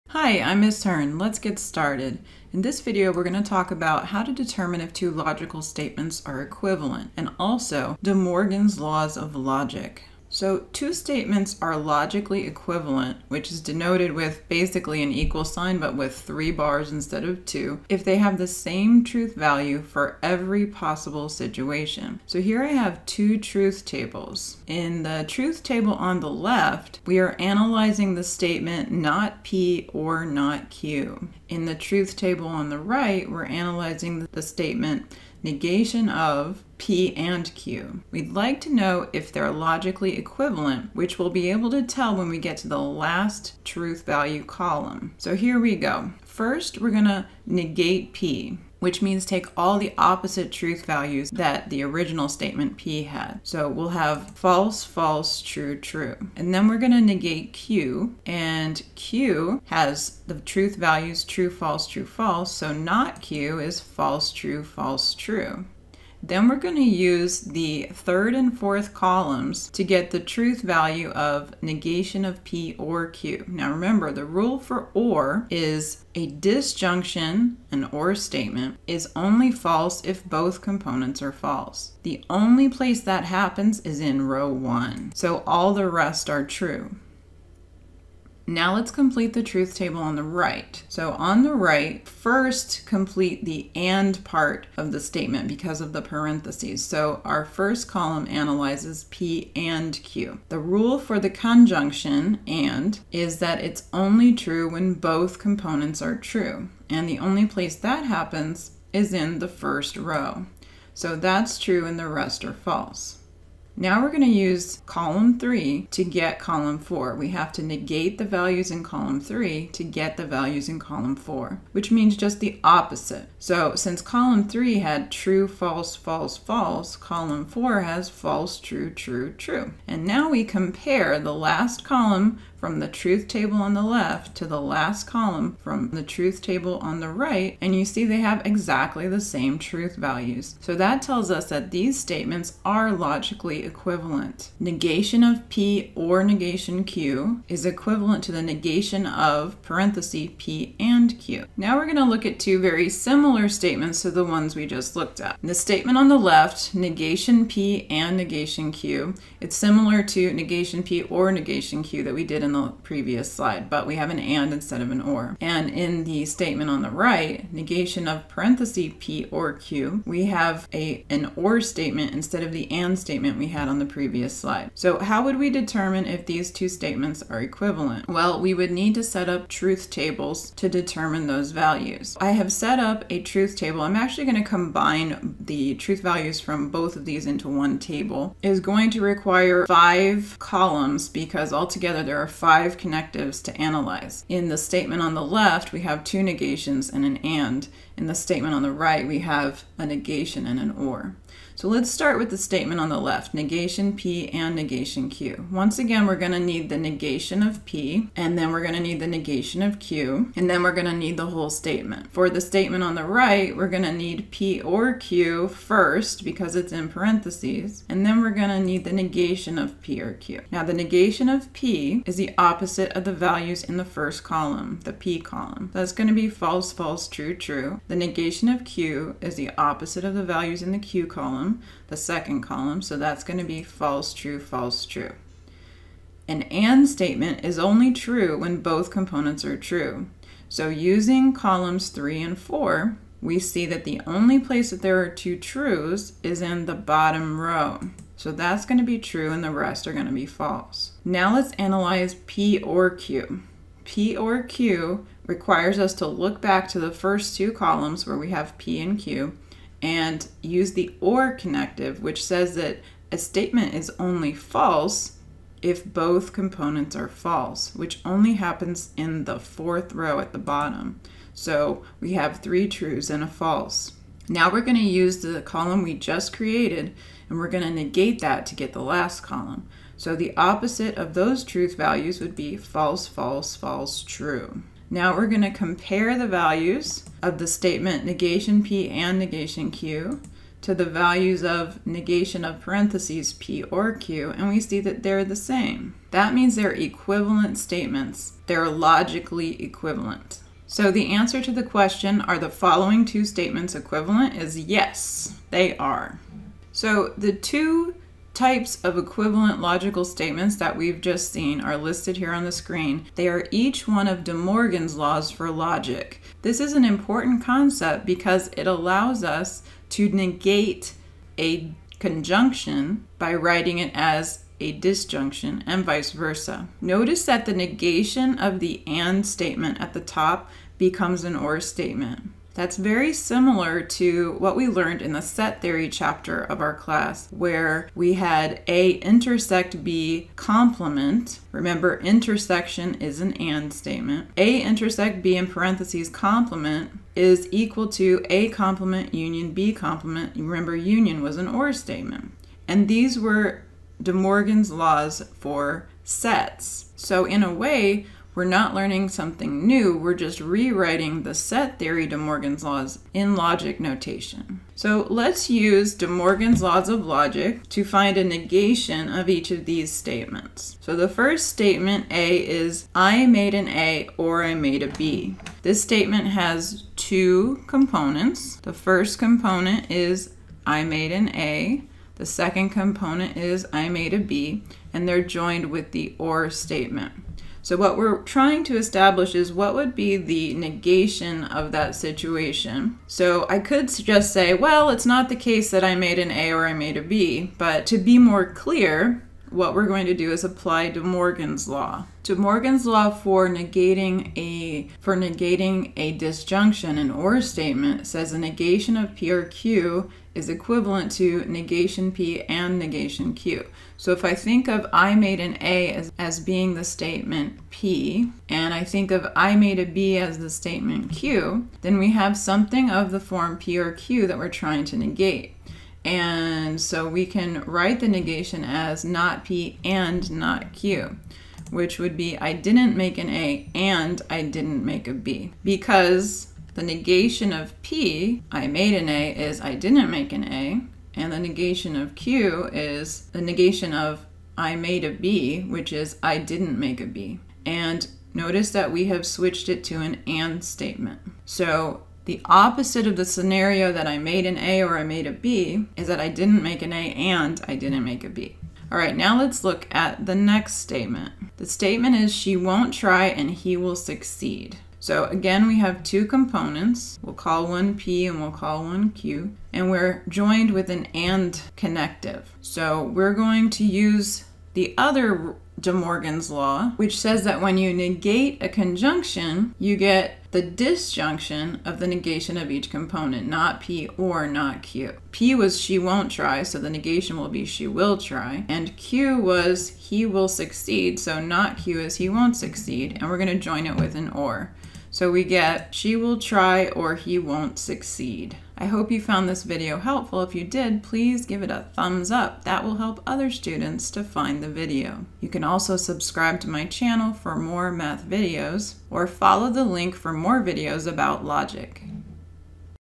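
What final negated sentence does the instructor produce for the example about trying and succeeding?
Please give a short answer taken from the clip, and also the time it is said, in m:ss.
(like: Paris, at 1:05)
she will try or he won't succeed, at 8:15.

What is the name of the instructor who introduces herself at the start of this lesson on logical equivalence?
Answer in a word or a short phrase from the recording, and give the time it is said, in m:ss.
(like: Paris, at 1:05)
Ms. Hearn, at 0:00.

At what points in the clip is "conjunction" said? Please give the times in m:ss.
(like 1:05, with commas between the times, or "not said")
1:41, 5:21, 7:58.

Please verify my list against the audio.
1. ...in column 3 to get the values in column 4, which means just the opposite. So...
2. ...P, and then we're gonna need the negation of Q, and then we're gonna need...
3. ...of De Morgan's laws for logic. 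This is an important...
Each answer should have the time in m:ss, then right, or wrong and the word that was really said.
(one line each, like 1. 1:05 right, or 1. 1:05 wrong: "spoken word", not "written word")
1. 1:58 right
2. 3:27 right
3. 5:14 right.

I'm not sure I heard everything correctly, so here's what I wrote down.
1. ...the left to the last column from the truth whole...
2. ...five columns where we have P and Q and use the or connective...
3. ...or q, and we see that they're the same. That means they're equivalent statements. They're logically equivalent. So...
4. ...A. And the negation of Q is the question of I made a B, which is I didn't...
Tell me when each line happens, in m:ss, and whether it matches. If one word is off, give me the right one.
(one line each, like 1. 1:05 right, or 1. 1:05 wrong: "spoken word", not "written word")
1. 2:13 wrong: "table", not "whole"
2. 4:17 wrong: "two", not "five"
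3. 4:53 right
4. 7:20 wrong: "negation", not "question".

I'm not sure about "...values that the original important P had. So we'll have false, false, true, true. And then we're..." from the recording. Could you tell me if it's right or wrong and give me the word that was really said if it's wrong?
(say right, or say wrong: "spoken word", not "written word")
wrong: "statement", not "important".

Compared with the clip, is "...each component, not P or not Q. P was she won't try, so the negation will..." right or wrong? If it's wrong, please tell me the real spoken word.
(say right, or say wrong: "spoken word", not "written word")
right.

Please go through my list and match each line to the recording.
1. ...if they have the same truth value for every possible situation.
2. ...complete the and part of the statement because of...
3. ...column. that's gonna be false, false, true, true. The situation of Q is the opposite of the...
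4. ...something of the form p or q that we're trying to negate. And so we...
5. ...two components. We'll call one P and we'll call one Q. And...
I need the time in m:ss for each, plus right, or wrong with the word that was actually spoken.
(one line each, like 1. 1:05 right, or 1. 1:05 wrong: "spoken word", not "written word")
1. 0:17 right
2. 1:32 right
3. 3:45 wrong: "negation", not "situation"
4. 7:02 right
5. 7:46 right.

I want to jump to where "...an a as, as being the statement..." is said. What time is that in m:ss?
6:55.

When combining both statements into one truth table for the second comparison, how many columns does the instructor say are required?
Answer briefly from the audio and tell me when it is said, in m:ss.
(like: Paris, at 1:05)
5, at 3:09.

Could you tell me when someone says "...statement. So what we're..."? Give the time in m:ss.
6:26.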